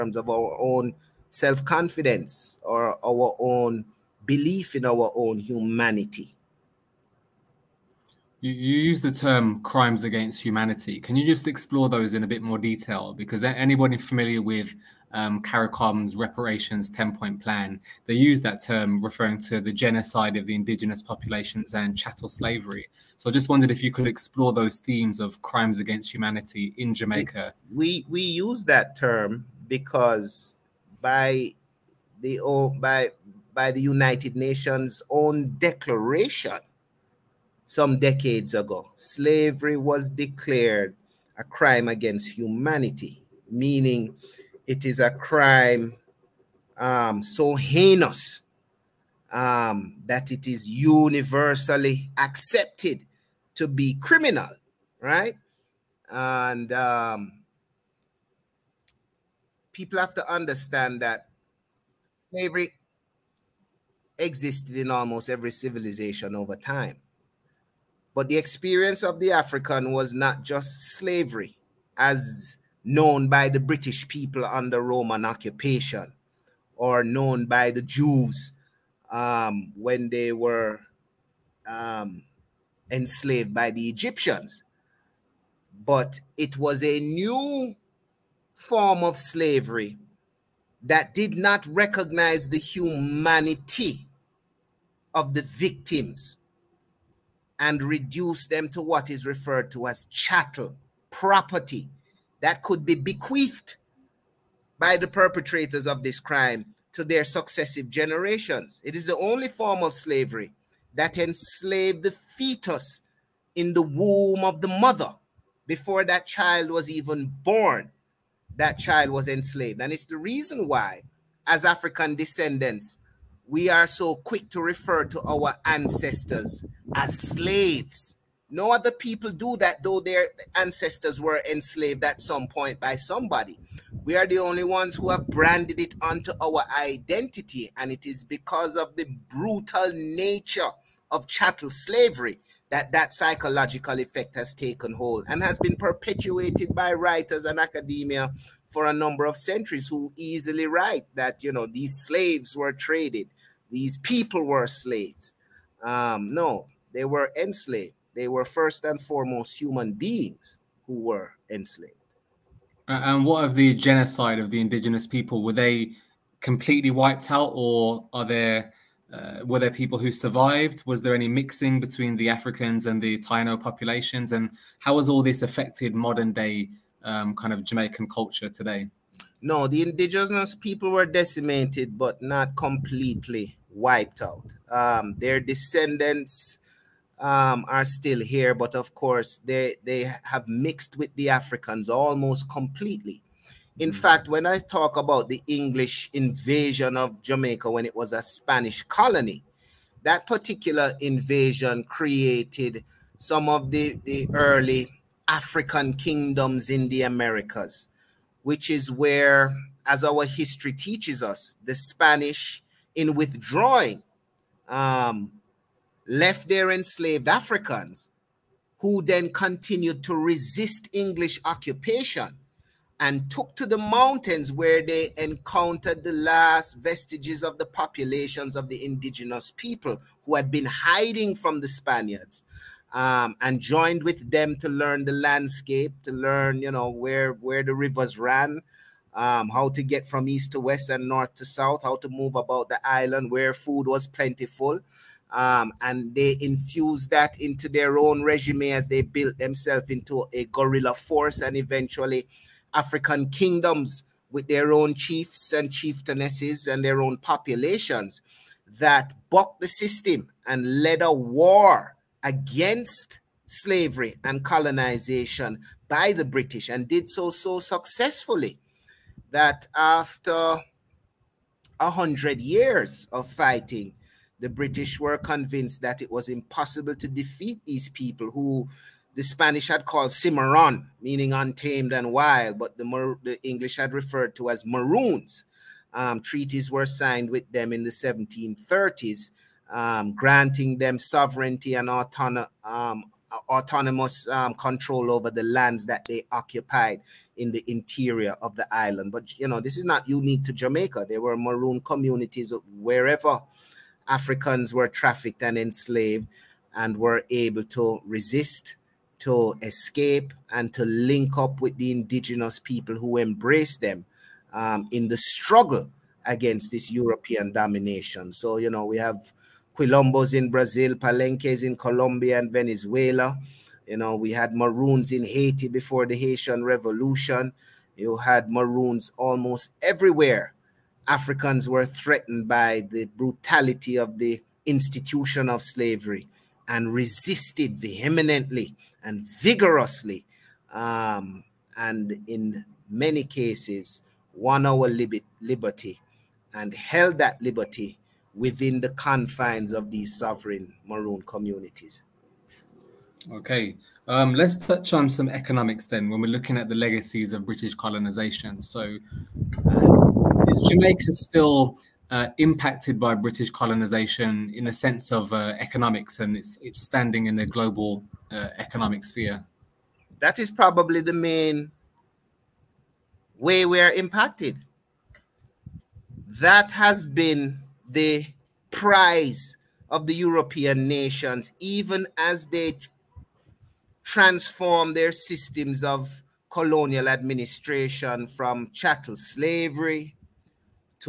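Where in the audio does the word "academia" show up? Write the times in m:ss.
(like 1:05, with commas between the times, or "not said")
2:27.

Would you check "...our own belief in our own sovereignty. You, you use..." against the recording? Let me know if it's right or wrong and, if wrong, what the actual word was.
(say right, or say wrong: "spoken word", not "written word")
wrong: "humanity", not "sovereignty".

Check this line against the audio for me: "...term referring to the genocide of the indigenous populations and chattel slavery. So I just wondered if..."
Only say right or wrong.
right.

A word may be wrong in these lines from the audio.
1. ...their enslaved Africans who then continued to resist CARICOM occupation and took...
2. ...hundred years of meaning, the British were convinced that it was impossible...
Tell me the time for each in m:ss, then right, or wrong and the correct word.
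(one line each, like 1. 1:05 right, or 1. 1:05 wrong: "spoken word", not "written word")
1. 3:36 wrong: "English", not "CARICOM"
2. 4:31 wrong: "fighting", not "meaning".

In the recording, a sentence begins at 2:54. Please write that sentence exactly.
And how has all this affected modern day um, kind of Jamaican culture today?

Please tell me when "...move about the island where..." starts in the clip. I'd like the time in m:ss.
4:02.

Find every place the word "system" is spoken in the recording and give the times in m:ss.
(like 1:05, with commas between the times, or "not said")
4:19, 6:25.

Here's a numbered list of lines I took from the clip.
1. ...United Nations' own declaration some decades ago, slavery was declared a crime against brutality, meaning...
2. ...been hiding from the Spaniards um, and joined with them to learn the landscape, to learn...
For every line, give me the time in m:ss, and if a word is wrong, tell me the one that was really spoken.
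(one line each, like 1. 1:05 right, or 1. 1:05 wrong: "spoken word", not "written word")
1. 0:33 wrong: "humanity", not "brutality"
2. 3:50 right.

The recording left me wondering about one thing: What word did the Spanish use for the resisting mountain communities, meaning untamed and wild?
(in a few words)
Cimarron.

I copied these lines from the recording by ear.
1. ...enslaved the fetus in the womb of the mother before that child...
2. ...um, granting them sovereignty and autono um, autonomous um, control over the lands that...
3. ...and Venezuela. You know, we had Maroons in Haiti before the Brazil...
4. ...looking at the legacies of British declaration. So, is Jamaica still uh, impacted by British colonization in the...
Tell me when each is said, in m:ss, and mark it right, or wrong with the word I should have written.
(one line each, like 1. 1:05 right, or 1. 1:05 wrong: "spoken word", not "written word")
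1. 1:51 right
2. 4:49 right
3. 5:22 wrong: "Haitian", not "Brazil"
4. 5:56 wrong: "colonization", not "declaration".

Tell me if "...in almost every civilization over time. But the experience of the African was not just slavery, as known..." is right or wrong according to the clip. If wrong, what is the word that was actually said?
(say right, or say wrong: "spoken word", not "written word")
right.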